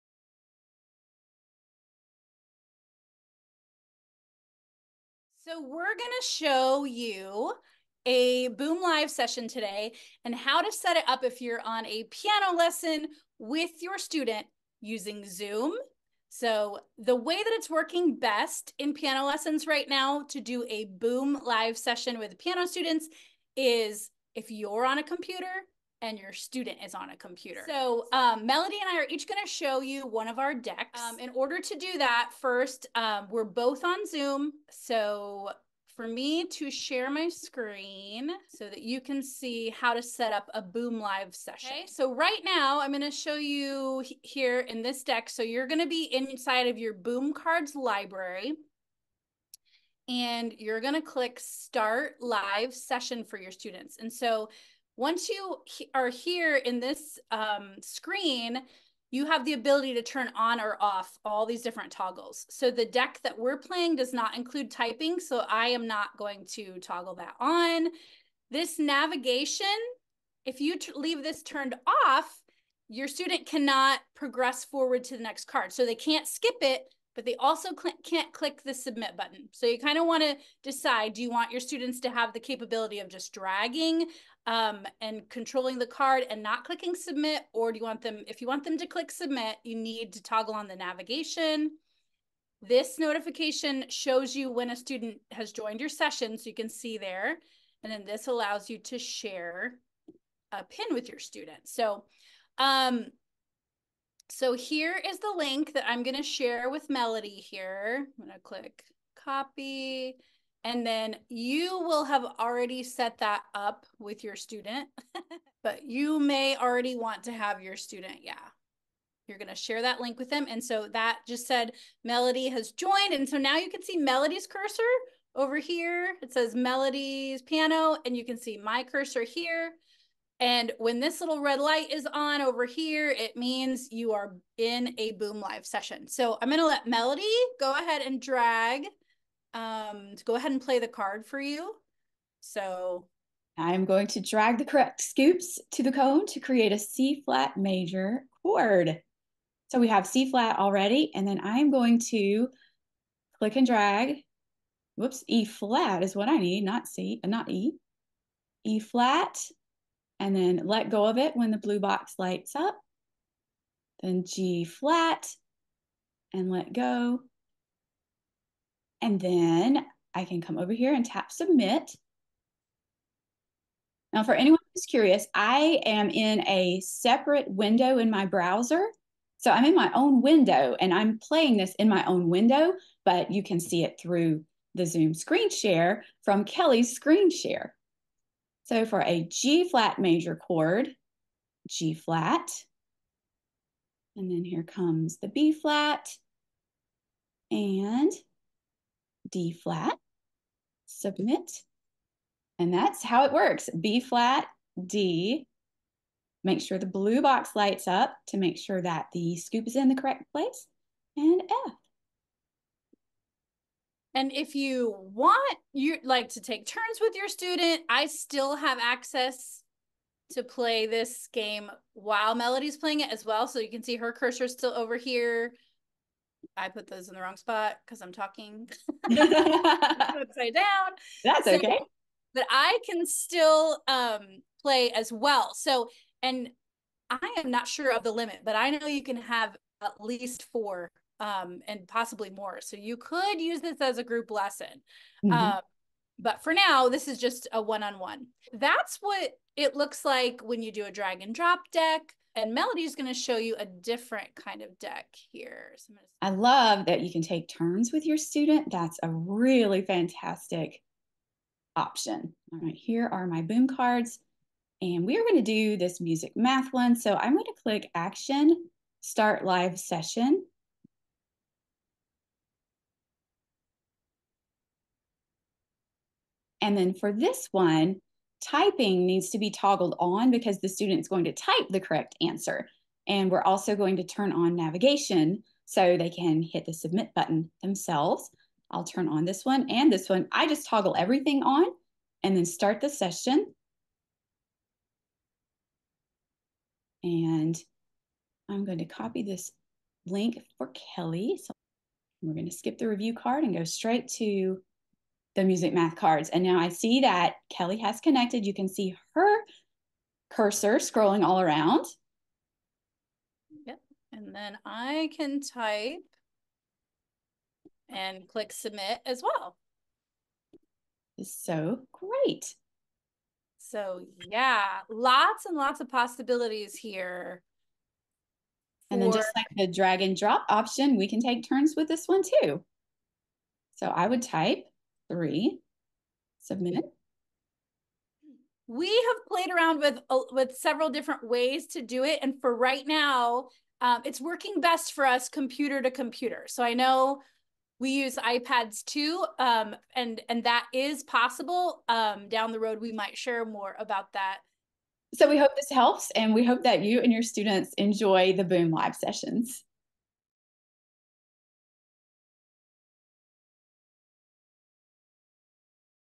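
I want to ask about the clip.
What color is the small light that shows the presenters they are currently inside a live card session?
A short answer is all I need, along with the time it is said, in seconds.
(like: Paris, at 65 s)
Red, at 131 s.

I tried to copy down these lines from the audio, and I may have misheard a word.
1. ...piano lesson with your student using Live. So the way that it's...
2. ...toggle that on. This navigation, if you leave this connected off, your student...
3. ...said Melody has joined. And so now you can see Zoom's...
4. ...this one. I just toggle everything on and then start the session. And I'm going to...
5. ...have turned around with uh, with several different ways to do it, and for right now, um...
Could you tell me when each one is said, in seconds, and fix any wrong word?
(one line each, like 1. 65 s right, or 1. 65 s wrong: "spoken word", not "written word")
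1. 12 s wrong: "Zoom", not "Live"
2. 66 s wrong: "turned", not "connected"
3. 121 s wrong: "Melody", not "Zoom"
4. 289 s right
5. 338 s wrong: "played", not "turned".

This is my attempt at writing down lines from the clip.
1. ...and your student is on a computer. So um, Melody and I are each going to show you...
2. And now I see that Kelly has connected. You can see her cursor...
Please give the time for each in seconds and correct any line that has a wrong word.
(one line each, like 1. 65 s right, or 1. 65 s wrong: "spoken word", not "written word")
1. 26 s right
2. 306 s right.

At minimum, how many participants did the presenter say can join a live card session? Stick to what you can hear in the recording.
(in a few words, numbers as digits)
4.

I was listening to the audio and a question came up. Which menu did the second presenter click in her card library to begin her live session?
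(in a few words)
Action.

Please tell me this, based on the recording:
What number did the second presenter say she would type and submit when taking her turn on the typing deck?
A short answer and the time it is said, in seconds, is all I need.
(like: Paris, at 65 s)
3, at 335 s.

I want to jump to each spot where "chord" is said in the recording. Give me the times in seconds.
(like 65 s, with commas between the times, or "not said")
148 s, 190 s.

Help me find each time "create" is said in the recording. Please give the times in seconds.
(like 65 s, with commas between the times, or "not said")
146 s.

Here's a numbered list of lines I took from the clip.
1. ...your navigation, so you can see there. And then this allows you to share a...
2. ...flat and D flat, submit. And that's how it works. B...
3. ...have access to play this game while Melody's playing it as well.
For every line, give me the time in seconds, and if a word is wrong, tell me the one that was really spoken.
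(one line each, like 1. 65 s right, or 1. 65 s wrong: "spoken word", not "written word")
1. 95 s wrong: "session", not "navigation"
2. 195 s right
3. 218 s right.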